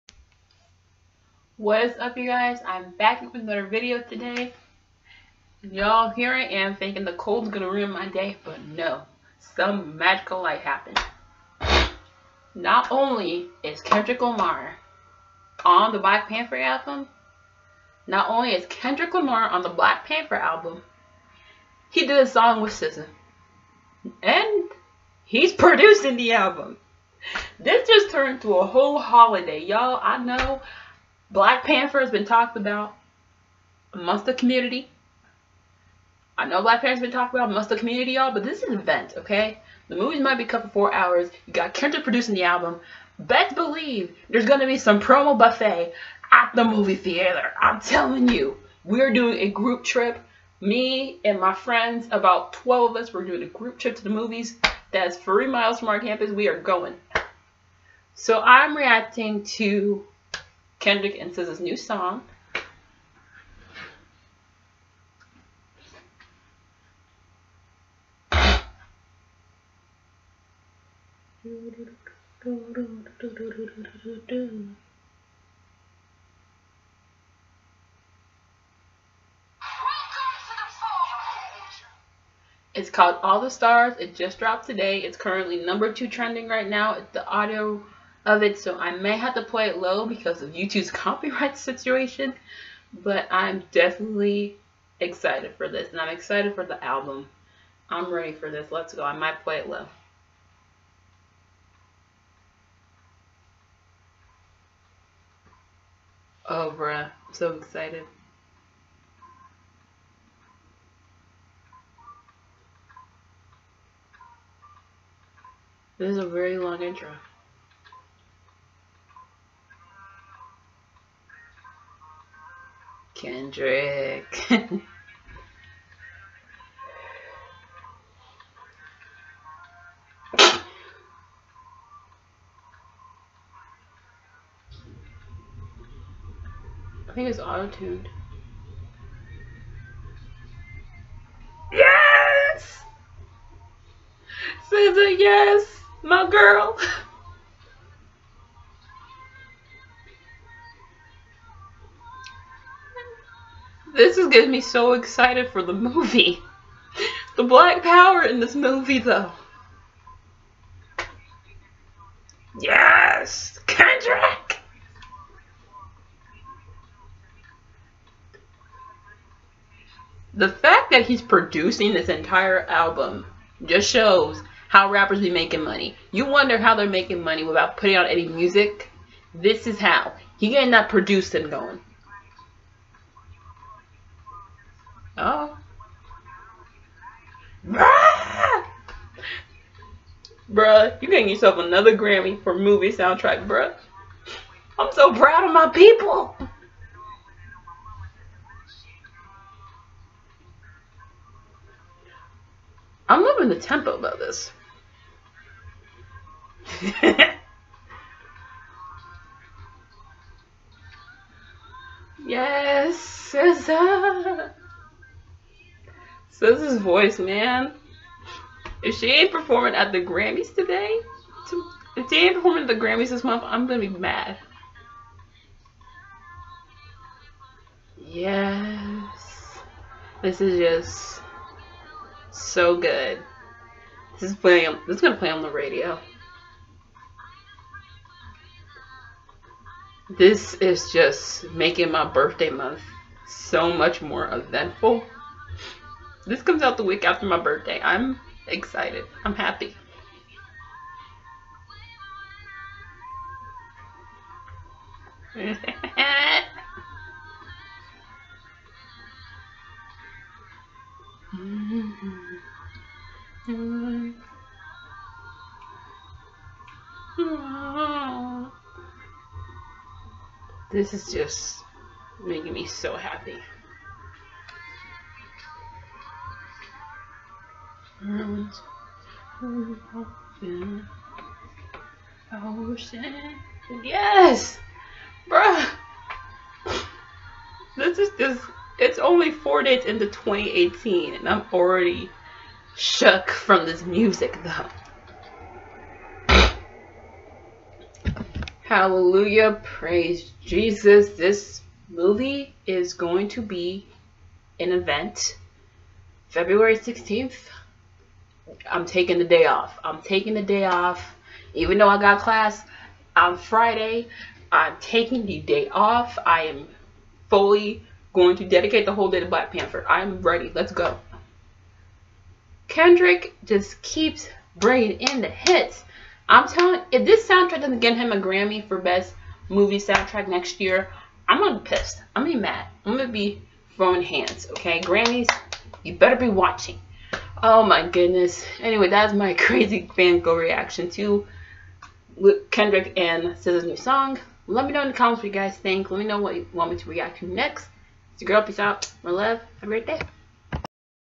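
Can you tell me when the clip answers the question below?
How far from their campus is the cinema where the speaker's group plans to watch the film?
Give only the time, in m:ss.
0:55.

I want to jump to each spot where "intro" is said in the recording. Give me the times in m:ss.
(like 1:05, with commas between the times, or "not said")
1:56.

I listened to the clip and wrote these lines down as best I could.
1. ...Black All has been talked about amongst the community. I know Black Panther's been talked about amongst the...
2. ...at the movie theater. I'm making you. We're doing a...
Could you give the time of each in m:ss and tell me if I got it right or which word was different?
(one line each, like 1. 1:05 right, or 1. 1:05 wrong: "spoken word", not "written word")
1. 0:31 wrong: "Panther", not "All"
2. 0:46 wrong: "telling", not "making".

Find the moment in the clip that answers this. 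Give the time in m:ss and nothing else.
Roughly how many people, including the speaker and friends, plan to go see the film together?
0:52.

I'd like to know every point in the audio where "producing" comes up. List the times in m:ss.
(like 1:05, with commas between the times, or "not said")
0:25, 0:42, 2:51, 3:00.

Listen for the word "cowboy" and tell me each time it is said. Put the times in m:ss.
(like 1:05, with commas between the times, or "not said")
not said.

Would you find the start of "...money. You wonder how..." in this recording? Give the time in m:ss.
2:55.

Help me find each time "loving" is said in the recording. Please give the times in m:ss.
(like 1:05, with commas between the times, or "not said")
3:23.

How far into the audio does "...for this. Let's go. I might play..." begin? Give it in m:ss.
1:38.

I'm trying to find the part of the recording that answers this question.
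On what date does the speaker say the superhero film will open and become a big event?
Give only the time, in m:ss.
5:06.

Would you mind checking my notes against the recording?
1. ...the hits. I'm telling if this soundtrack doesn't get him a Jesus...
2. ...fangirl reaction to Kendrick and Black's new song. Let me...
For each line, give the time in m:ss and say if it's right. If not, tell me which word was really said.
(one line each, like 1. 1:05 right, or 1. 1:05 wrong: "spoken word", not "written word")
1. 5:25 wrong: "Grammy", not "Jesus"
2. 5:39 wrong: "SZA", not "Black".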